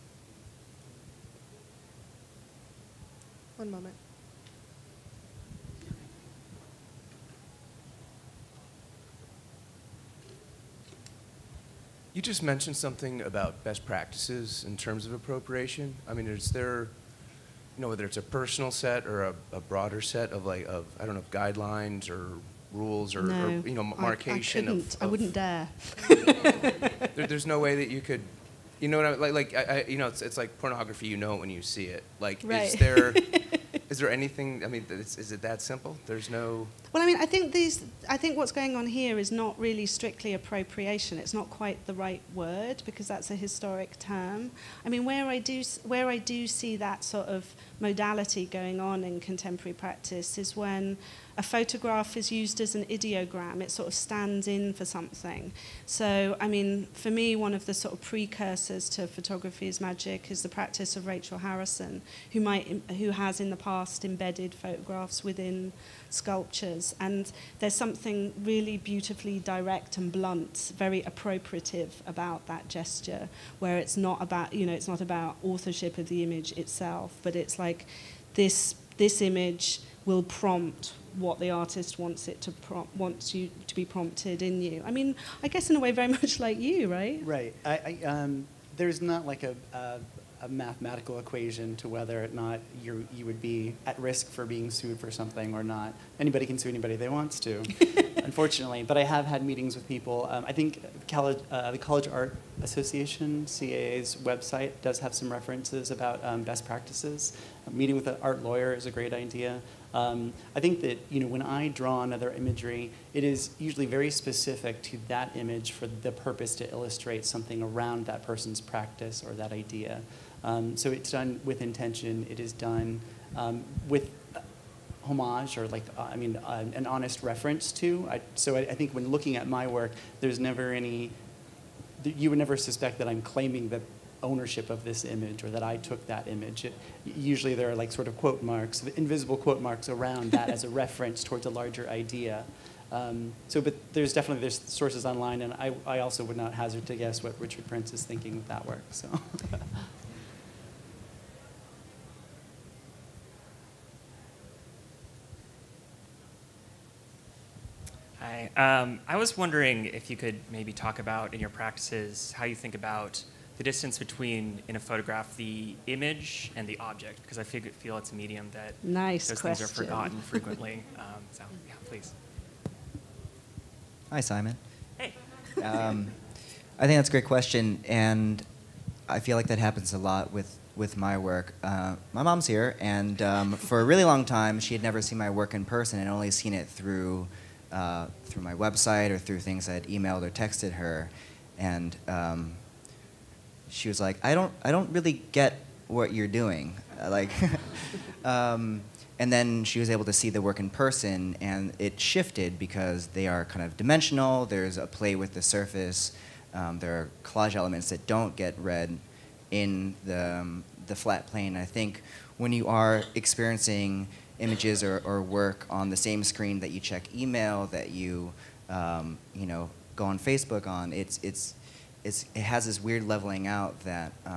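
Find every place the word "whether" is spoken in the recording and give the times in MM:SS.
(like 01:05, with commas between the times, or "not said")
00:17, 01:31.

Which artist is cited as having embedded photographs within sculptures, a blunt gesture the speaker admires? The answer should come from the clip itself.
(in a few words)
Rachel Harrison.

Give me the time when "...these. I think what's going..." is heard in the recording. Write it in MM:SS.
00:37.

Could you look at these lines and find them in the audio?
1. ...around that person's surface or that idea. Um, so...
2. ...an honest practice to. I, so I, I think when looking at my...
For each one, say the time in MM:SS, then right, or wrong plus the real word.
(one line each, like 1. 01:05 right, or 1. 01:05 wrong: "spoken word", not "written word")
1. 01:57 wrong: "practice", not "surface"
2. 02:06 wrong: "reference", not "practice".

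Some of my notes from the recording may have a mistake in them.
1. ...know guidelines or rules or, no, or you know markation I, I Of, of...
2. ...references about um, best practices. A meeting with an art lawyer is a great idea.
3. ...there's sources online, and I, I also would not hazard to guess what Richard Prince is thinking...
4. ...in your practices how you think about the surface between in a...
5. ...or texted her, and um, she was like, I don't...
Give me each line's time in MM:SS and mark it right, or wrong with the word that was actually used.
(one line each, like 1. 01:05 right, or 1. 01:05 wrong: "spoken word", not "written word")
1. 00:21 right
2. 01:45 right
3. 02:24 right
4. 02:41 wrong: "distance", not "surface"
5. 03:10 right.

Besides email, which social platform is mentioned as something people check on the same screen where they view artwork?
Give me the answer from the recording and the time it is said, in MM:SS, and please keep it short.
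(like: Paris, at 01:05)
Facebook, at 03:40.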